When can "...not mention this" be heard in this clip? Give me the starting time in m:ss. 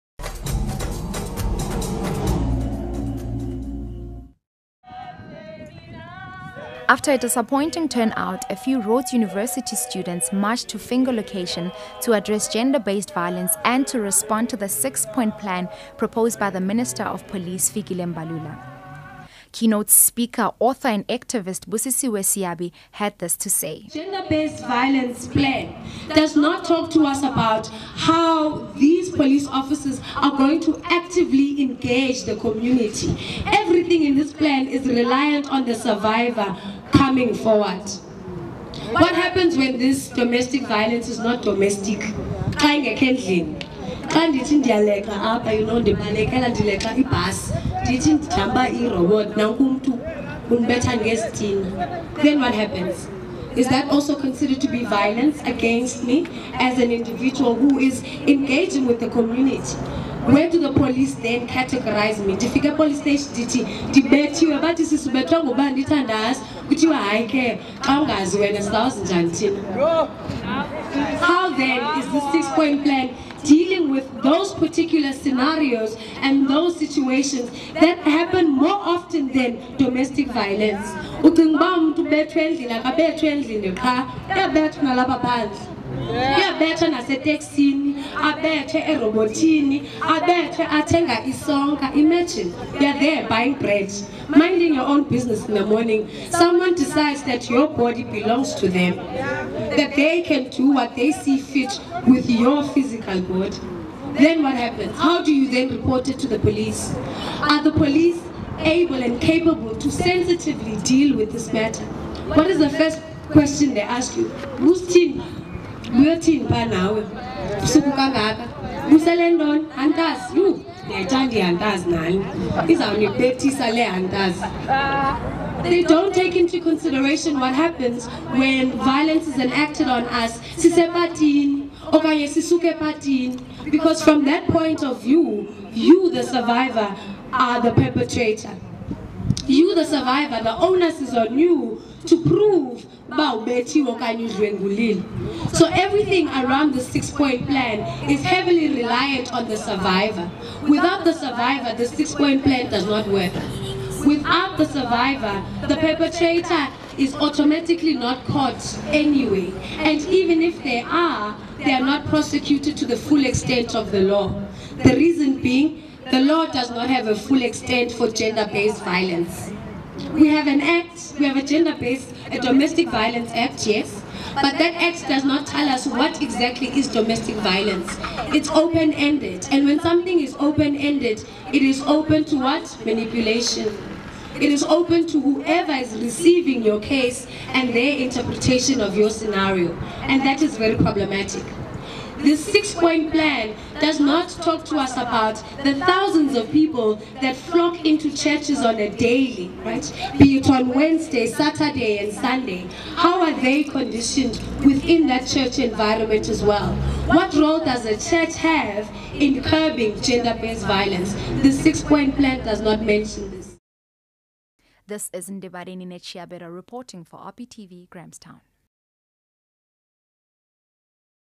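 3:32.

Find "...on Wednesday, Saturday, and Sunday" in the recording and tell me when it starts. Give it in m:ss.
3:20.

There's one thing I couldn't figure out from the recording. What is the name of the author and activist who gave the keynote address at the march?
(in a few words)
Busisiwe Seabe.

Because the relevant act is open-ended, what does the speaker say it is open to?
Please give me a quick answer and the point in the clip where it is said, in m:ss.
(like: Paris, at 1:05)
Manipulation, at 3:02.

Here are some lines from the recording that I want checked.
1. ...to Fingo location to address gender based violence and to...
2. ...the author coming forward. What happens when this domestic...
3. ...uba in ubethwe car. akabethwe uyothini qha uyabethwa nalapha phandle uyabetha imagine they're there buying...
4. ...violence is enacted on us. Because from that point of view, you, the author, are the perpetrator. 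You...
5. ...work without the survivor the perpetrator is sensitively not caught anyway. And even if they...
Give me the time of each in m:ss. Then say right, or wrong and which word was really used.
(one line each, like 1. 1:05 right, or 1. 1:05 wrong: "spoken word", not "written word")
1. 0:10 right
2. 0:35 wrong: "survivor", not "author"
3. 1:21 wrong: "endlini", not "uyothini"
4. 2:08 wrong: "survivor", not "author"
5. 2:33 wrong: "automatically", not "sensitively".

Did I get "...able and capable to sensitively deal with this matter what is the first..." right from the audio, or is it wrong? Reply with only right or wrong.
right.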